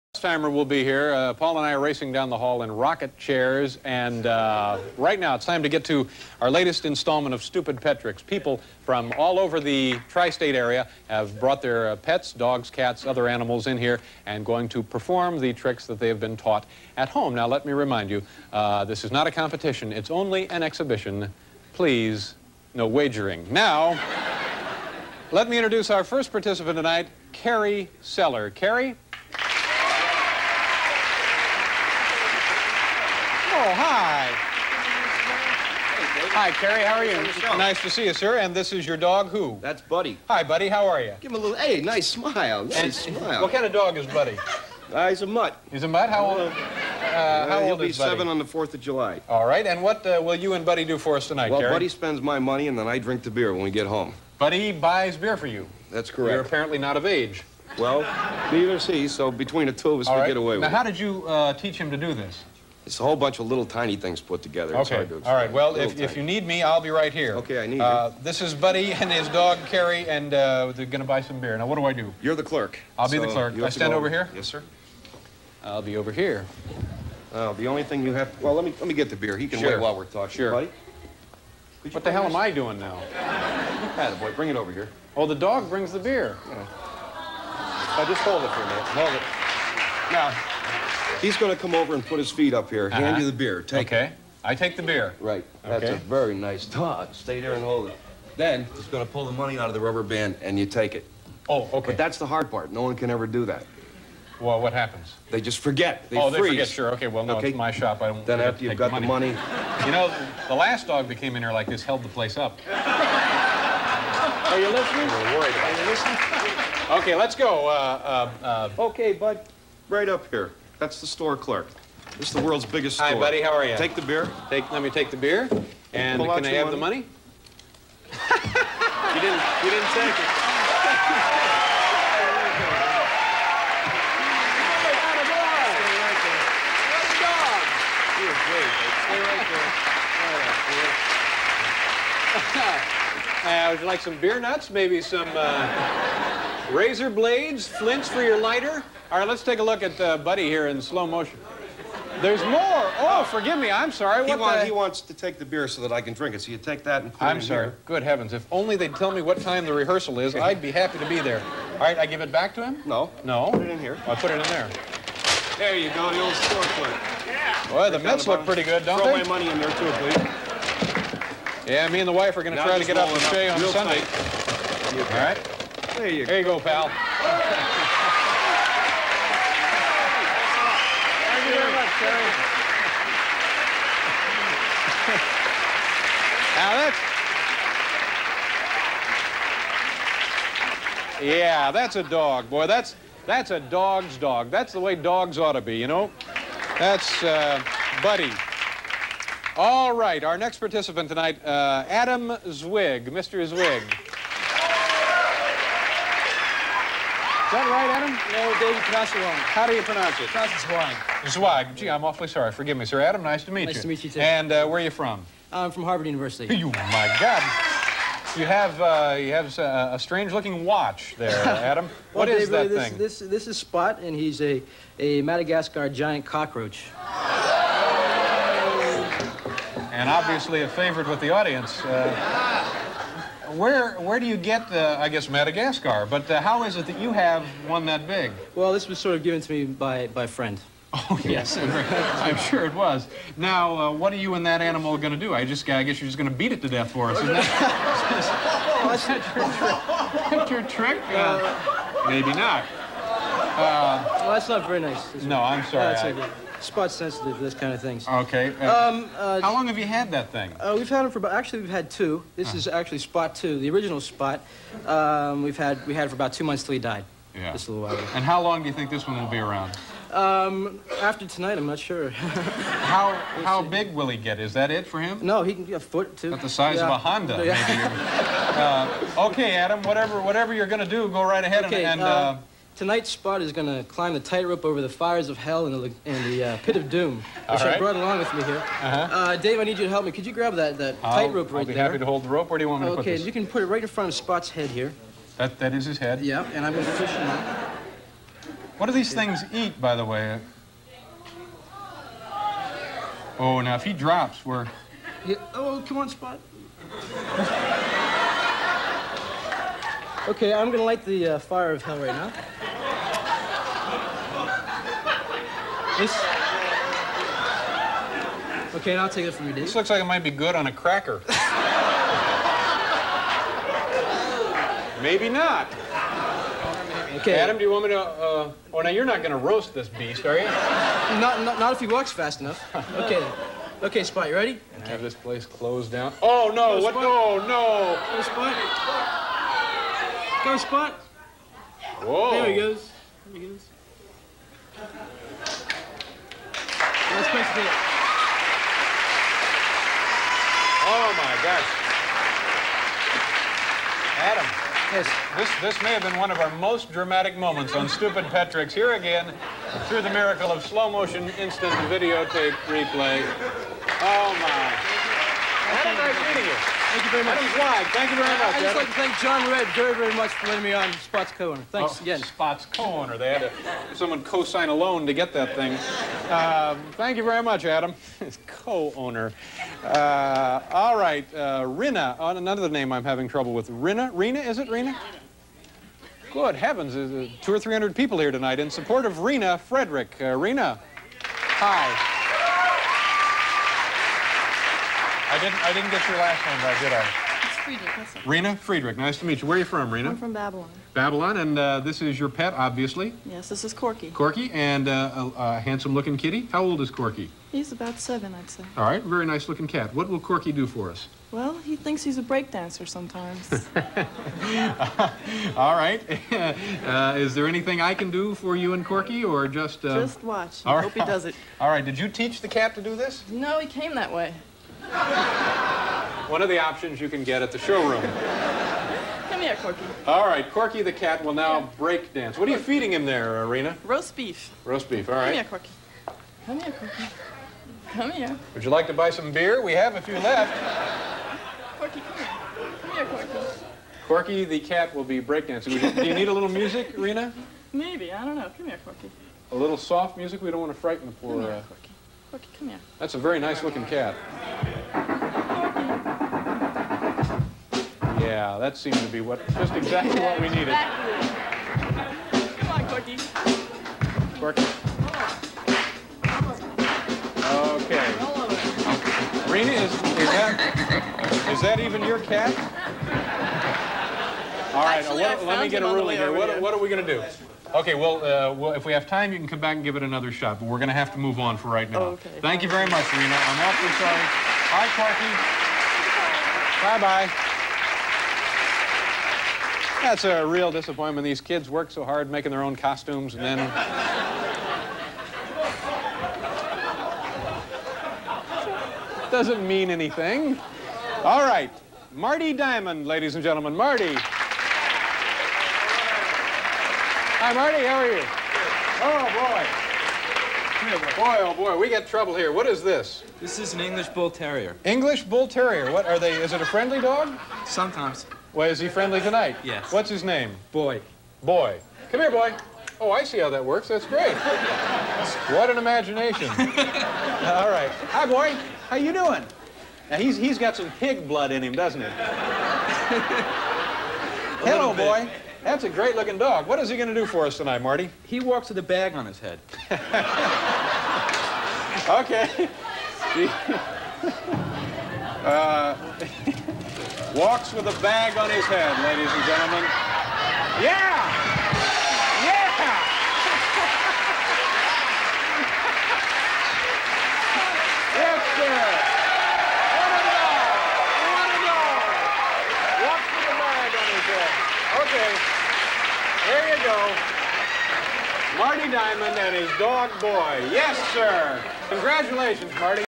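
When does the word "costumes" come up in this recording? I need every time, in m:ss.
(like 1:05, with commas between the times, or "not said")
8:12.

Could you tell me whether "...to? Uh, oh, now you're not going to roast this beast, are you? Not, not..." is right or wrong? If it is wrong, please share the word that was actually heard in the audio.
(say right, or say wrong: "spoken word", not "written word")
right.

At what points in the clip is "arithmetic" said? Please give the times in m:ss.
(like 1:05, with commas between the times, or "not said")
not said.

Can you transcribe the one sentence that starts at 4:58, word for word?
What do these things eat, by the way?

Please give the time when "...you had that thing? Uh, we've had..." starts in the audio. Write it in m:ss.
4:19.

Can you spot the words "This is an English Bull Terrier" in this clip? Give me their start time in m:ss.
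8:33.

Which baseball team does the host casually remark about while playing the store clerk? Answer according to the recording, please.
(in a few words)
The Mets.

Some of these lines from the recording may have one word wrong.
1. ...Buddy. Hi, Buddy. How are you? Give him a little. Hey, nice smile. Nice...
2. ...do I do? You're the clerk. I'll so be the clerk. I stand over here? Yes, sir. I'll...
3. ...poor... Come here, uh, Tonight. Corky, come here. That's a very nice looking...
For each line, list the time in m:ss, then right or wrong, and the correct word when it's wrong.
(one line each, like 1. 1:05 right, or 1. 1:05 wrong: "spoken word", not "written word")
1. 0:39 right
2. 1:11 right
3. 7:31 wrong: "Corky", not "Tonight".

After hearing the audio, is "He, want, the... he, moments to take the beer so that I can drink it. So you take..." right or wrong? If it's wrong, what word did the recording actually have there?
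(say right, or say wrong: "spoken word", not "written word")
wrong: "wants", not "moments".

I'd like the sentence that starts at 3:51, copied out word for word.
Uh, where where do you get the I guess Madagascar?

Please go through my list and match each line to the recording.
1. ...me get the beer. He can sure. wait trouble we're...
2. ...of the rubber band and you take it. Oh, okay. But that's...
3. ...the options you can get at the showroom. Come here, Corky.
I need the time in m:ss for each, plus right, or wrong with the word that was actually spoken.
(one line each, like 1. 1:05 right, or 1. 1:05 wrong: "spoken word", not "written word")
1. 1:18 wrong: "while", not "trouble"
2. 1:39 right
3. 7:06 right.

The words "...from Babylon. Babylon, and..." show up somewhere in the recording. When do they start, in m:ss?
6:40.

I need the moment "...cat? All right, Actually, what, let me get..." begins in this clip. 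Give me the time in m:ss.
7:52.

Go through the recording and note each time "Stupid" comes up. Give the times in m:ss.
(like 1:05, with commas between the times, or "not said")
0:07, 5:57.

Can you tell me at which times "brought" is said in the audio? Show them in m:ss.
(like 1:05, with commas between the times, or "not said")
0:11, 4:47.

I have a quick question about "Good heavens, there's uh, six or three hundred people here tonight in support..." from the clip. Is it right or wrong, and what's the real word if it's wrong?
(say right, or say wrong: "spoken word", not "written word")
wrong: "two", not "six".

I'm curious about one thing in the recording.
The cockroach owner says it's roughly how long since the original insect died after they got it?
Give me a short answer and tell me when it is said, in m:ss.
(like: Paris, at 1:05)
About two months, at 4:26.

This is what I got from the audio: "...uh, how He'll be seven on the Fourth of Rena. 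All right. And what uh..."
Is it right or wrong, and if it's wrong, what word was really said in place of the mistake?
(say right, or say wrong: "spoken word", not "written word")
wrong: "July", not "Rena".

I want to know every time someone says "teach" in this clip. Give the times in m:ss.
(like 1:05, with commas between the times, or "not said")
1:01, 7:02.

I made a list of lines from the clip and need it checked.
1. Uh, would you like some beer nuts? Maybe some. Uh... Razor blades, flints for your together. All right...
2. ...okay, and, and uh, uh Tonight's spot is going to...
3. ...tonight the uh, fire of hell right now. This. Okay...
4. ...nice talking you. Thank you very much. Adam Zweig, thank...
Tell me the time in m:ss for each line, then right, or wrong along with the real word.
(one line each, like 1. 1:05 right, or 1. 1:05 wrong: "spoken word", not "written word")
1. 2:23 wrong: "lighter", not "together"
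2. 4:41 right
3. 5:10 wrong: "light", not "tonight"
4. 6:05 wrong: "meeting", not "talking".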